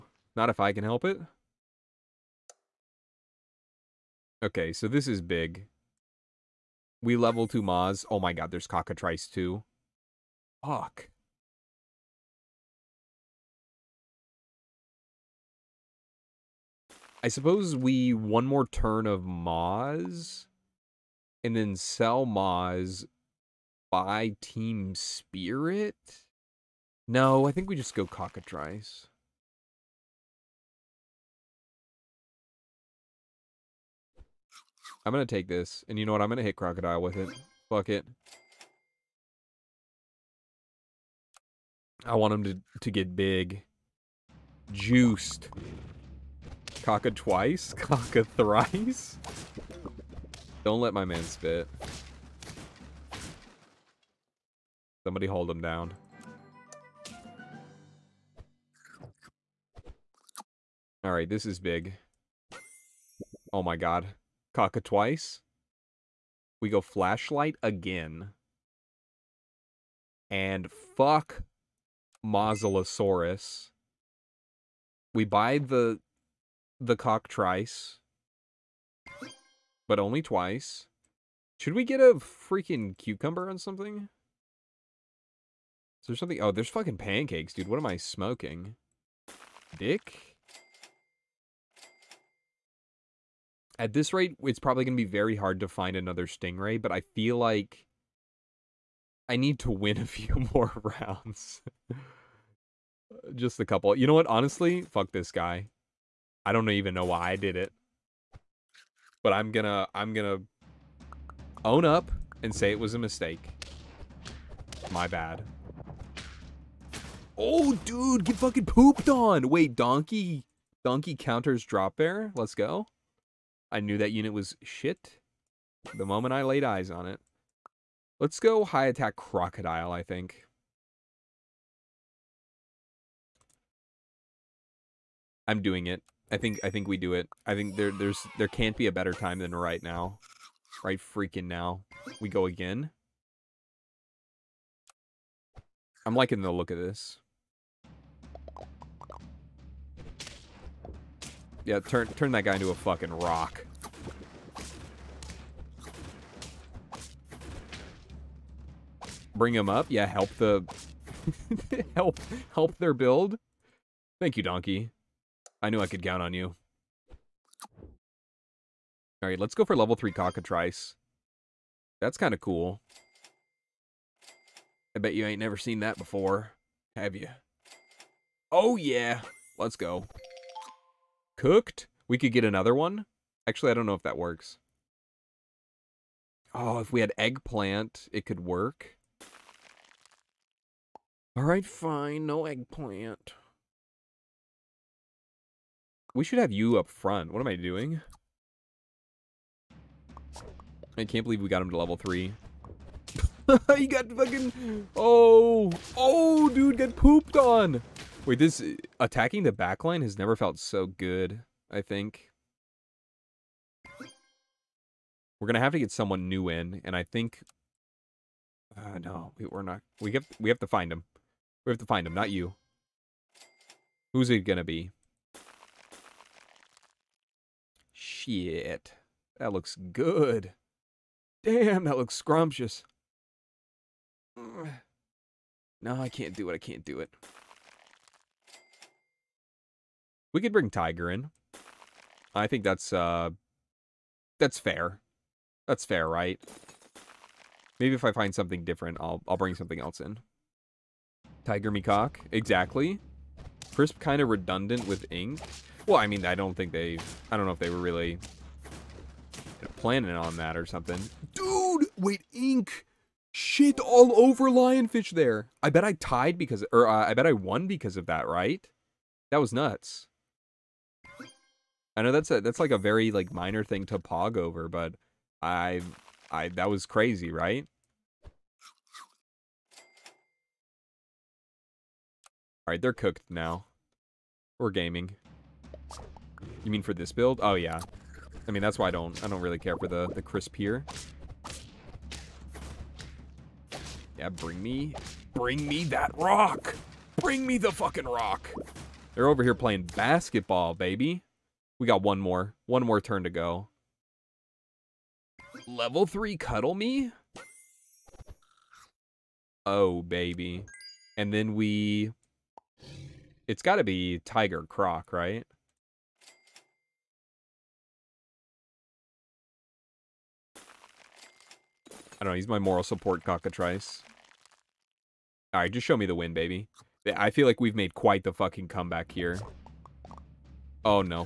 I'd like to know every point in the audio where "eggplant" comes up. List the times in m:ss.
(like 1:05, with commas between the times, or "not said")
3:07, 3:12.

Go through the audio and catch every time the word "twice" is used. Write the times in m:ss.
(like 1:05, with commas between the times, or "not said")
0:47, 1:04, 1:20.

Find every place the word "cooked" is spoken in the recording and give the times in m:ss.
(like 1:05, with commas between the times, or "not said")
3:01, 4:42.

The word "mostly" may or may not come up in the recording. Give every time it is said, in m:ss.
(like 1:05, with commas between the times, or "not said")
not said.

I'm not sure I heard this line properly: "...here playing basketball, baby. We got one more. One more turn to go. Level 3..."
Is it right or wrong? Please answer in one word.
right.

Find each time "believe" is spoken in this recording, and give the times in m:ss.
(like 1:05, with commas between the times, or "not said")
3:21.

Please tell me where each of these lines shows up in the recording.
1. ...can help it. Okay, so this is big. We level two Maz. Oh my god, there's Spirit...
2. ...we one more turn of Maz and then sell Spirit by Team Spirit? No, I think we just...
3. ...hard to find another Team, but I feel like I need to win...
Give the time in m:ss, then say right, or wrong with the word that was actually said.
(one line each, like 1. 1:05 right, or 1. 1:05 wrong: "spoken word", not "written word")
1. 0:00 wrong: "Cockatrice", not "Spirit"
2. 0:17 wrong: "Maz", not "Spirit"
3. 1:35 wrong: "Stingray", not "Team".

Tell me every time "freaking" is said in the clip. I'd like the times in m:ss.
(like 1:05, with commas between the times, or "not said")
1:22, 2:20.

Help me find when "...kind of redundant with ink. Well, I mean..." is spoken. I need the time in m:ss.
4:13.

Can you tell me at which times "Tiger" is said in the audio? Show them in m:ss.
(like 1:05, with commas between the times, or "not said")
4:00, 4:11, 5:14.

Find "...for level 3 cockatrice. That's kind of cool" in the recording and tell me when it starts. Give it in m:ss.
2:49.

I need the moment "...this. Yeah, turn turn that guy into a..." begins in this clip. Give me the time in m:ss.
2:26.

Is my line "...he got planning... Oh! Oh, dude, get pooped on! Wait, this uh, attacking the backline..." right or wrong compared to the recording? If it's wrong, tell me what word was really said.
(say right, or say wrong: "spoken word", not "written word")
wrong: "fucking", not "planning".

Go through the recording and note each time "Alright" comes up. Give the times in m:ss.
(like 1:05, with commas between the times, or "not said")
1:01, 3:11.